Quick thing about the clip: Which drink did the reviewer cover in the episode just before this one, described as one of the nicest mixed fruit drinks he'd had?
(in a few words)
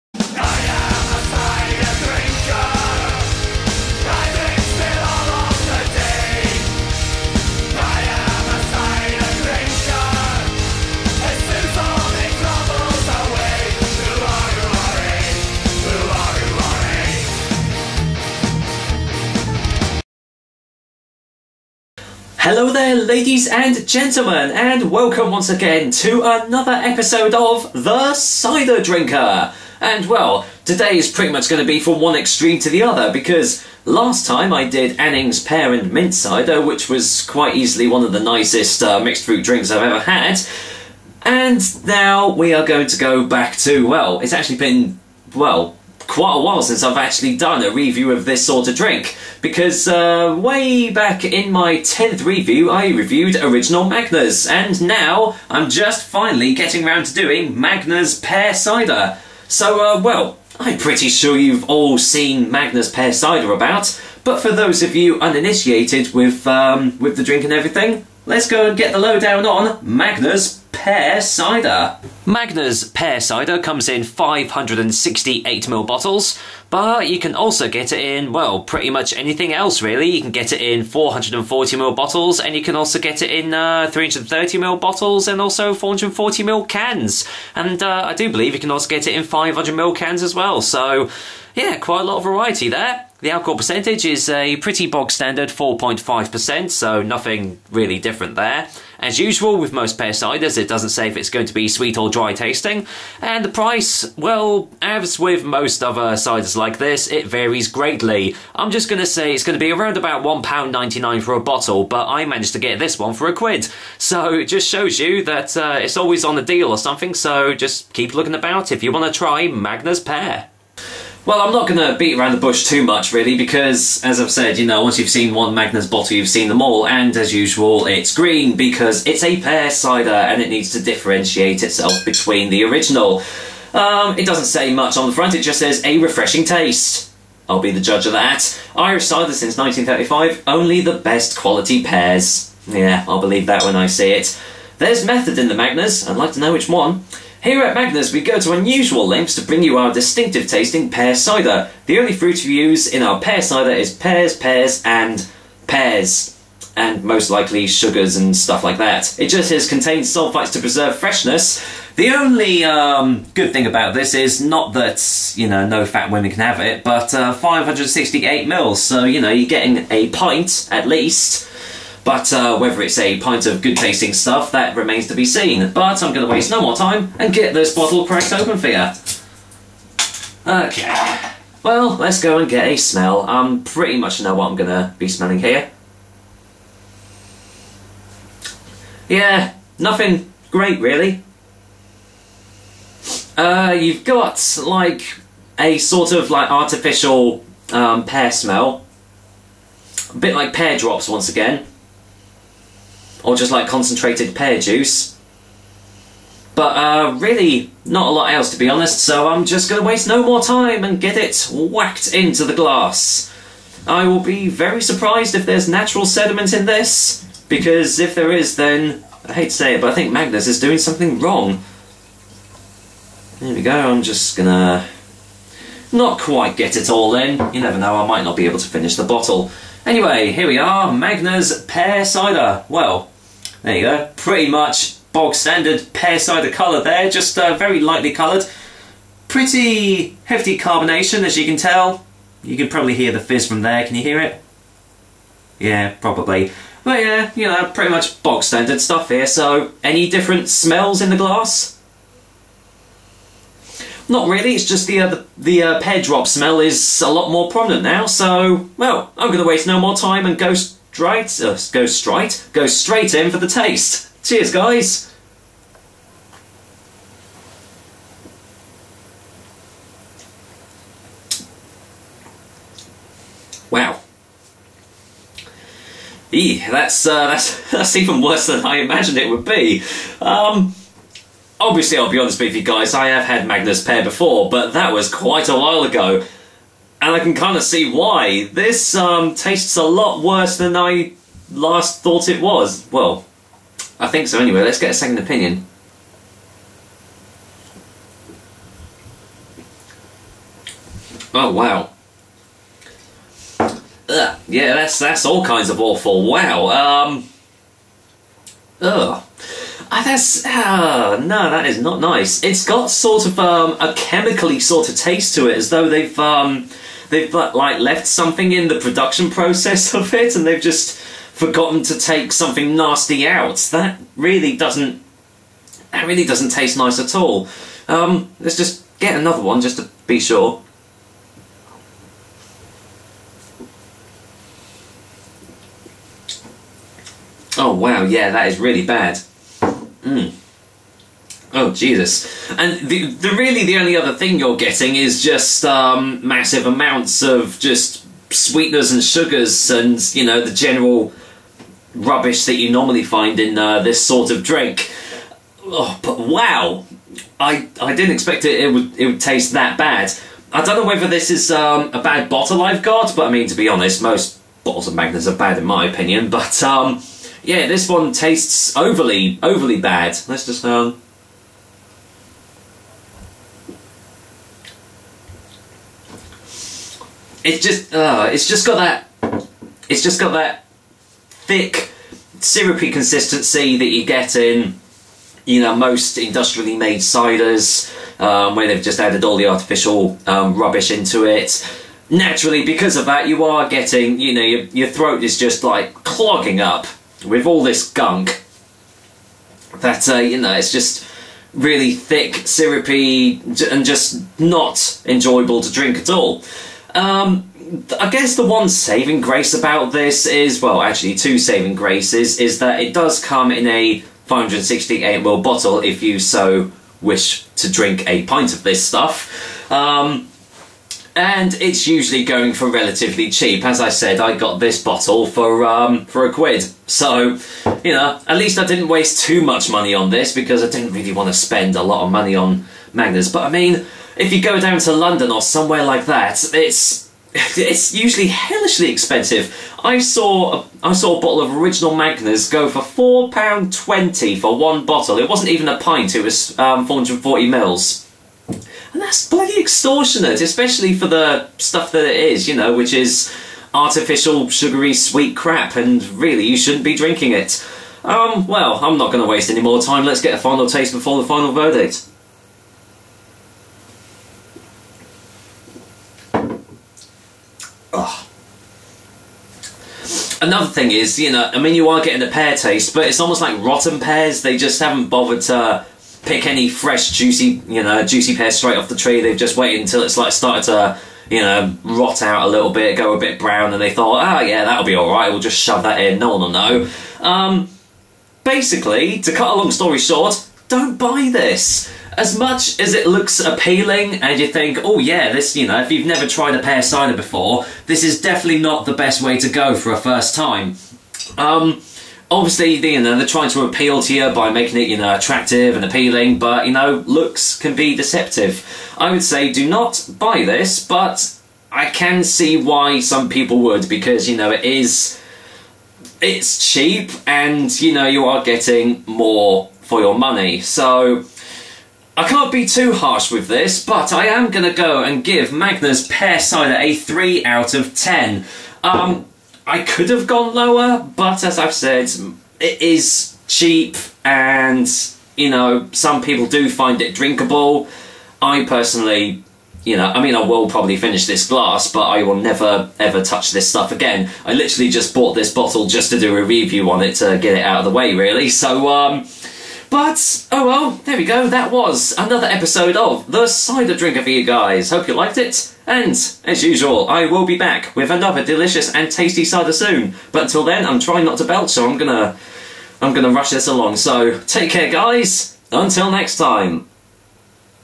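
Anning's Pear and Mint Cider.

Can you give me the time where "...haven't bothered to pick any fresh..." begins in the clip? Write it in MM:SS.
07:54.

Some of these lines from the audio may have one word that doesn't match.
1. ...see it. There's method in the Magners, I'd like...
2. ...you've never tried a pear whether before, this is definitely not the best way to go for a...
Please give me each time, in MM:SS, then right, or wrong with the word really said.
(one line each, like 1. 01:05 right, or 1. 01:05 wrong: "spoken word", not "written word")
1. 02:23 right
2. 08:15 wrong: "cider", not "whether".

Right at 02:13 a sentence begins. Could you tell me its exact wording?
Um, it doesn't say much on the front, it just says, a refreshing taste.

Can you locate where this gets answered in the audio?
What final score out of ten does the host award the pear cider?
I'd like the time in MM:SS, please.
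08:46.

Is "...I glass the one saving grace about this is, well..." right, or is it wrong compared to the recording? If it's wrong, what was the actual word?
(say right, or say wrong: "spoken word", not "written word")
wrong: "guess", not "glass".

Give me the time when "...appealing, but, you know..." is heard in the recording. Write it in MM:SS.
08:25.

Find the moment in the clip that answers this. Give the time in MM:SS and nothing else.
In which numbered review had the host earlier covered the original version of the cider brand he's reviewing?
00:51.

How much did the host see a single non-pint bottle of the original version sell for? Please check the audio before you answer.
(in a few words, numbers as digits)
£4.20.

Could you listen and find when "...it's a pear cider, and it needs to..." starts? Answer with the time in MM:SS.
02:09.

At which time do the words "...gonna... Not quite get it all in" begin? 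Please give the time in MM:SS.
03:44.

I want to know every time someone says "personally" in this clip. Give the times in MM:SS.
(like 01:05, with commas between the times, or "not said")
08:58.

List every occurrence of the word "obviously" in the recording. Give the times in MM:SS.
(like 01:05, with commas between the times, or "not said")
04:41, 08:22.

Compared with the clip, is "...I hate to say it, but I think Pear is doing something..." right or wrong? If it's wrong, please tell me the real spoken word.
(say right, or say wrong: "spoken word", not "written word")
wrong: "Magners", not "Pear".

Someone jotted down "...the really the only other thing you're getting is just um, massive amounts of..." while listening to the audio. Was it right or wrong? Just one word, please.
right.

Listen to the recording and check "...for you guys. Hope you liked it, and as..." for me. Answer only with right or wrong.
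right.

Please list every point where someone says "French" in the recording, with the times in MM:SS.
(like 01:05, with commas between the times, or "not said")
not said.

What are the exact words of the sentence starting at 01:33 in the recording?
The alcohol percentage is a pretty bog standard 4.5%, so nothing really different there.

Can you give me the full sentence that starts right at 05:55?
Oh, but wow, I I didn't expect it.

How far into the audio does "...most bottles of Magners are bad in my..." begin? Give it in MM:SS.
06:04.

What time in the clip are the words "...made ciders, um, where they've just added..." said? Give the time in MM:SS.
06:26.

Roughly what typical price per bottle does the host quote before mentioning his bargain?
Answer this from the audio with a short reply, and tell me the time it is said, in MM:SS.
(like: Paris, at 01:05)
£1.99, at 01:50.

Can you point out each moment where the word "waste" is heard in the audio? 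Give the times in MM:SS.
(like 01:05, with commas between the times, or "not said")
02:56, 03:29, 04:19, 07:08, 07:39.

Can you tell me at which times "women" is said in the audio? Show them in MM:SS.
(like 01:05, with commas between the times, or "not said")
02:46.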